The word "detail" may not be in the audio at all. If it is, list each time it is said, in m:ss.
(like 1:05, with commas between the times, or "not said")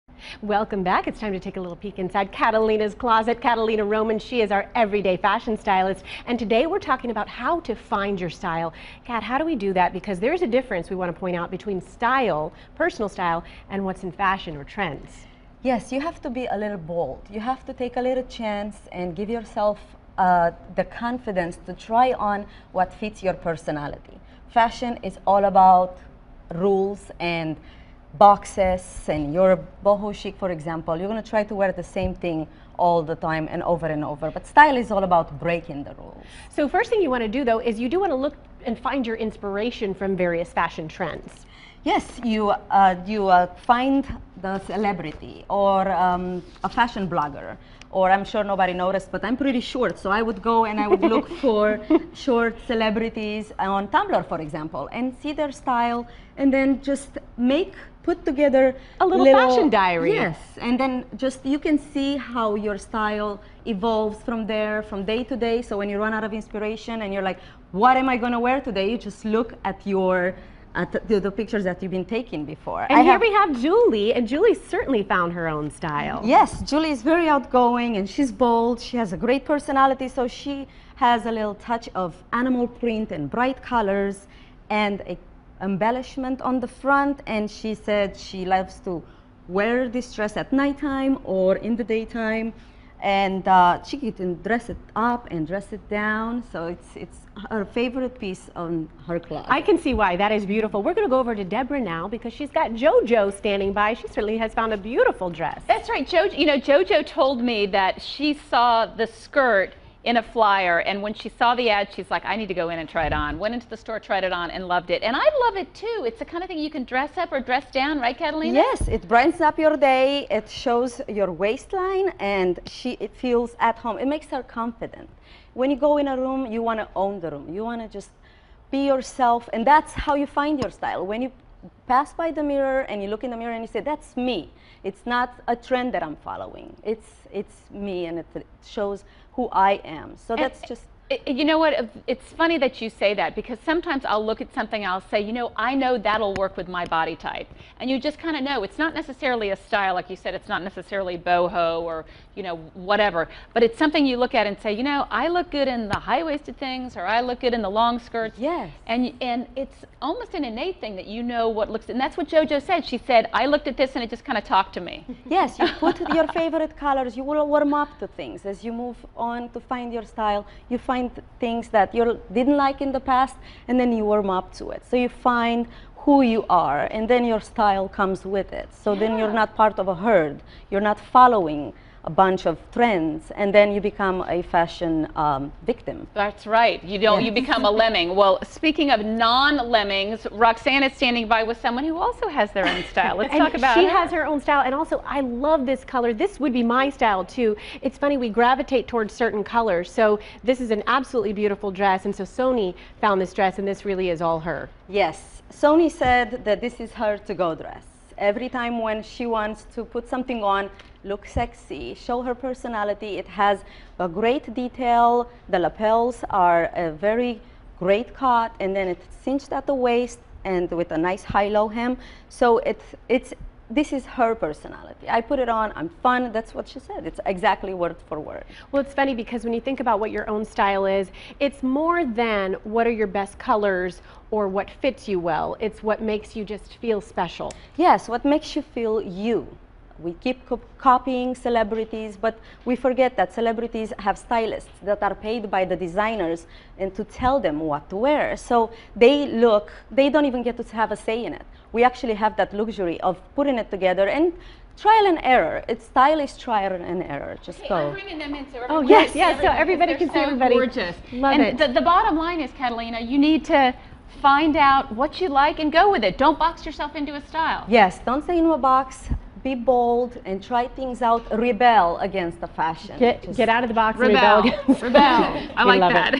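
3:34.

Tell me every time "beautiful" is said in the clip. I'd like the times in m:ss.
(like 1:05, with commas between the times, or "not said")
1:40, 1:44, 3:21.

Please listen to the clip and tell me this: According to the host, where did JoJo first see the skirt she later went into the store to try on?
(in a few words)
In a flyer.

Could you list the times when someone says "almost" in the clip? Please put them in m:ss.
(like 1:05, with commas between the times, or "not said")
2:40.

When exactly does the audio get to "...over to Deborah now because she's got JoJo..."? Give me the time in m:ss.
1:41.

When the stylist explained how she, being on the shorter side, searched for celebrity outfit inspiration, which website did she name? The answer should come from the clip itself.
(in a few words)
Tumblr.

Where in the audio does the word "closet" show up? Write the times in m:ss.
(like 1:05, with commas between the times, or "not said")
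0:02, 1:39.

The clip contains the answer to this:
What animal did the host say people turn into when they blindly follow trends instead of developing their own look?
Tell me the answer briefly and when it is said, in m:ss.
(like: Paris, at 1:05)
Lemming, at 3:07.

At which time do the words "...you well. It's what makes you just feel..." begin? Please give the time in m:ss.
3:55.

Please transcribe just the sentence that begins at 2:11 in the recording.
When you pass by the mirror and you look in the mirror and you say, that's me.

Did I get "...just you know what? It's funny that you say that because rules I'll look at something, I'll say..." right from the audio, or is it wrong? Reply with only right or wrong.
wrong.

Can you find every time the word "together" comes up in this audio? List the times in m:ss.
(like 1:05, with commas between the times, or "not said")
0:58, 4:13.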